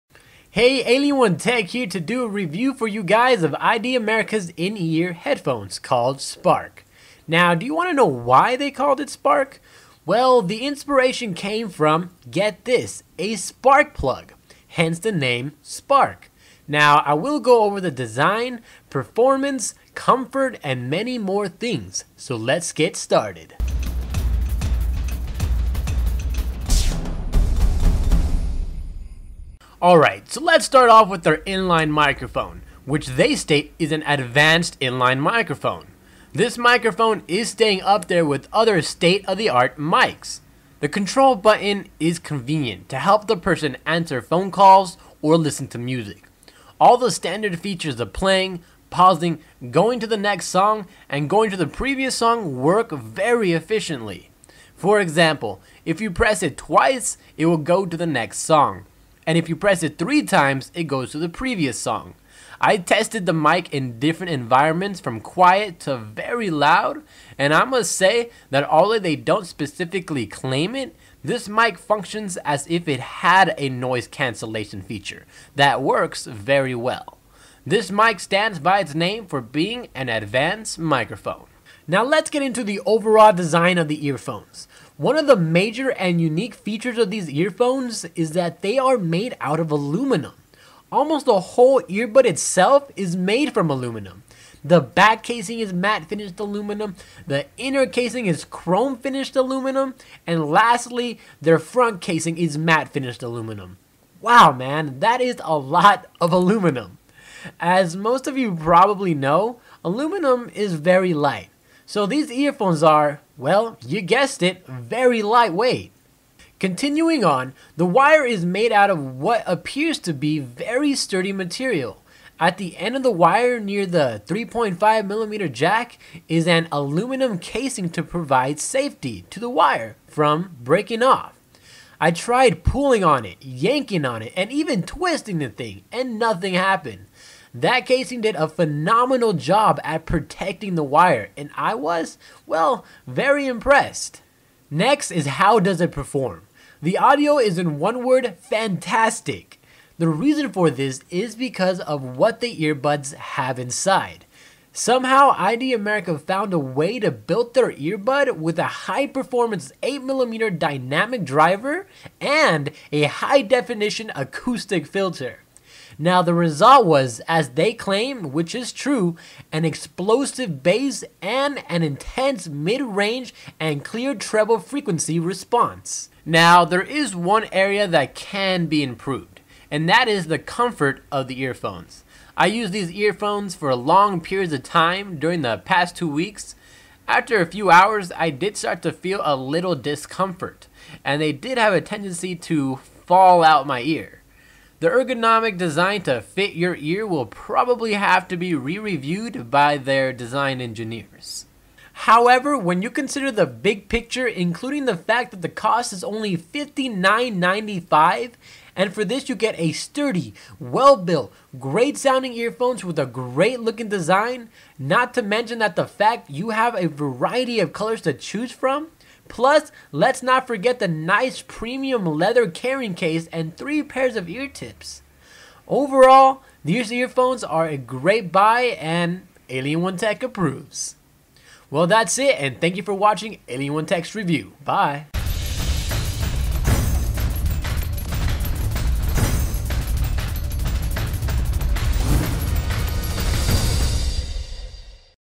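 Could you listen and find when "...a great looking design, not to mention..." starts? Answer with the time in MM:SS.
03:32.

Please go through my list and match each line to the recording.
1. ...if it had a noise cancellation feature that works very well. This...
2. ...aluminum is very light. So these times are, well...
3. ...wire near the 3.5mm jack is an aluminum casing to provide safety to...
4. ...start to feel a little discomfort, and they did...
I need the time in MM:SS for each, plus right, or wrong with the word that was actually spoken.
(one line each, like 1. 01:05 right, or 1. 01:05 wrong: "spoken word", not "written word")
1. 01:12 right
2. 01:49 wrong: "earphones", not "times"
3. 02:03 right
4. 03:08 right.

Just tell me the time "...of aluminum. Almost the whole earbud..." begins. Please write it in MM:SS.
01:29.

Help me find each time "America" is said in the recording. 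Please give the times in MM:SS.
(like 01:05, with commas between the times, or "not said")
00:03, 02:35.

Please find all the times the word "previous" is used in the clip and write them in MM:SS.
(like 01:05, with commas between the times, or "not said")
00:51, 01:01.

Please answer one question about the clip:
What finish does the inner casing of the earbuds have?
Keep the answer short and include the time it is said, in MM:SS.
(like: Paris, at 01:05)
Chrome finished, at 01:38.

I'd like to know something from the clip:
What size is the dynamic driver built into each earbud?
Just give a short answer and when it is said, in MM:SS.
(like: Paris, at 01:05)
8mm, at 02:39.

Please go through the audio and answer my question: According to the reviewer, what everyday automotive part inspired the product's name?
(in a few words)
Spark plug.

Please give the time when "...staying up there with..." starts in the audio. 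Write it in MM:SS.
00:37.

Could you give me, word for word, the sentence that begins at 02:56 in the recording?
Now, there is one area that can be improved, and that is the comfort of the earphones.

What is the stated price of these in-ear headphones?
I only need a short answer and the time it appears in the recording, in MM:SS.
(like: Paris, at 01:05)
$59.95, at 03:26.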